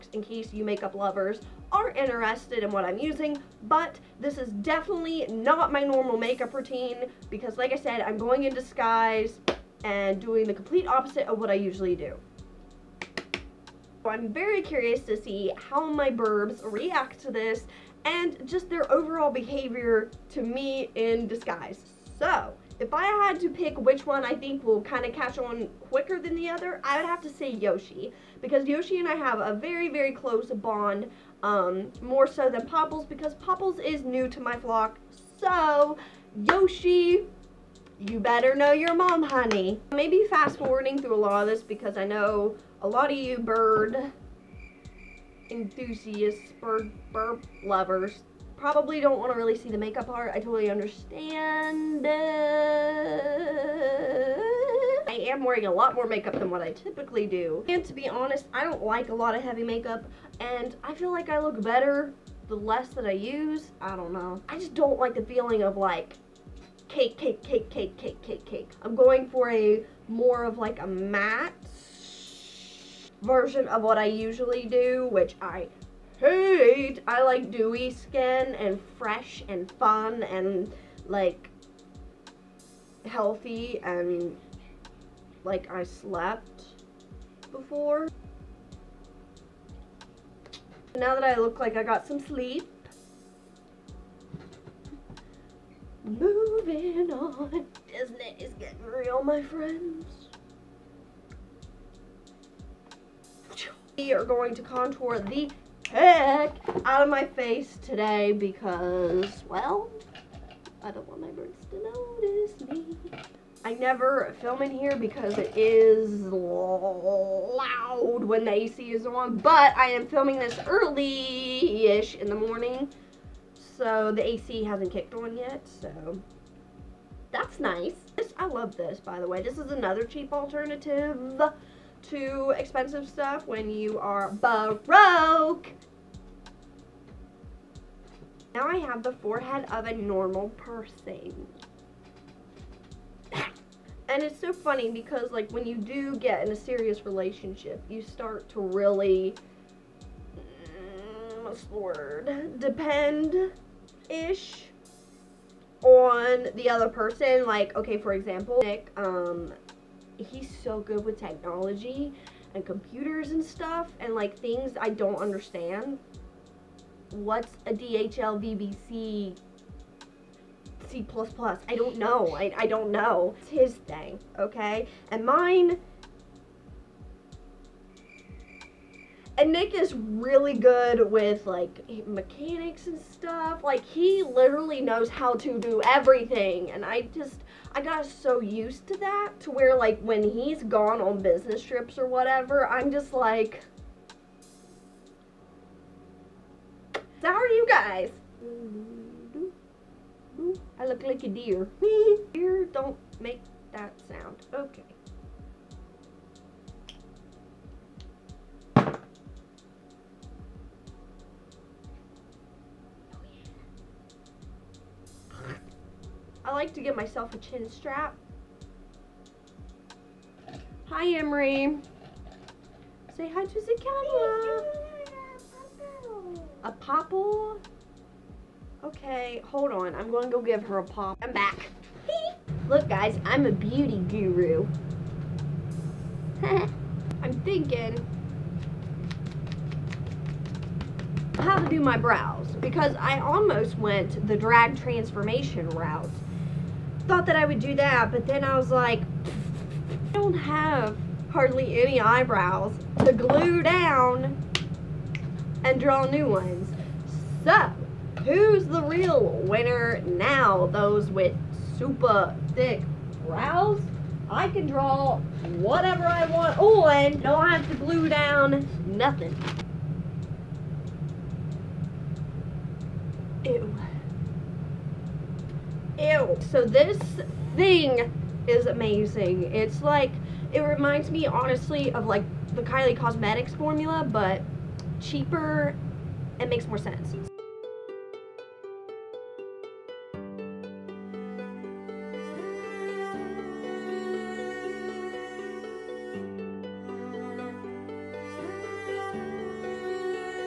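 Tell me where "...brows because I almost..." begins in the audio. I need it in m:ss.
4:01.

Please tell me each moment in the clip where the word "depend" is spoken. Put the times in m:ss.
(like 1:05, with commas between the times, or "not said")
2:32.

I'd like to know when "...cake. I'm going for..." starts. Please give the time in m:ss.
1:08.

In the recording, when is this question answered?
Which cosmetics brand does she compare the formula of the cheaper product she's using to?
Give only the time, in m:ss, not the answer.
4:42.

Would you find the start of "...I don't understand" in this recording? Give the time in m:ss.
2:44.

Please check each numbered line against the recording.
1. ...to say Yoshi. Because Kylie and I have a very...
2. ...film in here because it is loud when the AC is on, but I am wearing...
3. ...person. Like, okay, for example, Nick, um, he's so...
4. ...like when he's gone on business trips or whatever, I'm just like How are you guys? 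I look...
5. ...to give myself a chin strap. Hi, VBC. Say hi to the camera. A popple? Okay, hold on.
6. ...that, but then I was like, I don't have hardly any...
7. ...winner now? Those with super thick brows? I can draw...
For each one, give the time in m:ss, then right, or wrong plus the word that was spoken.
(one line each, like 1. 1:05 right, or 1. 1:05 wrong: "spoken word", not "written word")
1. 0:27 wrong: "Yoshi", not "Kylie"
2. 1:54 wrong: "filming", not "wearing"
3. 2:36 right
4. 3:09 right
5. 3:36 wrong: "Emery", not "VBC"
6. 4:07 right
7. 4:19 right.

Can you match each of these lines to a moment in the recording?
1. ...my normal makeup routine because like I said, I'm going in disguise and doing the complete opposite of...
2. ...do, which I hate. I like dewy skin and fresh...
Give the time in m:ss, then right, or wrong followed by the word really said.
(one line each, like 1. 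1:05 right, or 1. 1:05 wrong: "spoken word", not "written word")
1. 0:05 right
2. 1:14 right.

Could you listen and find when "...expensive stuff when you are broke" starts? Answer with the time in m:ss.
2:12.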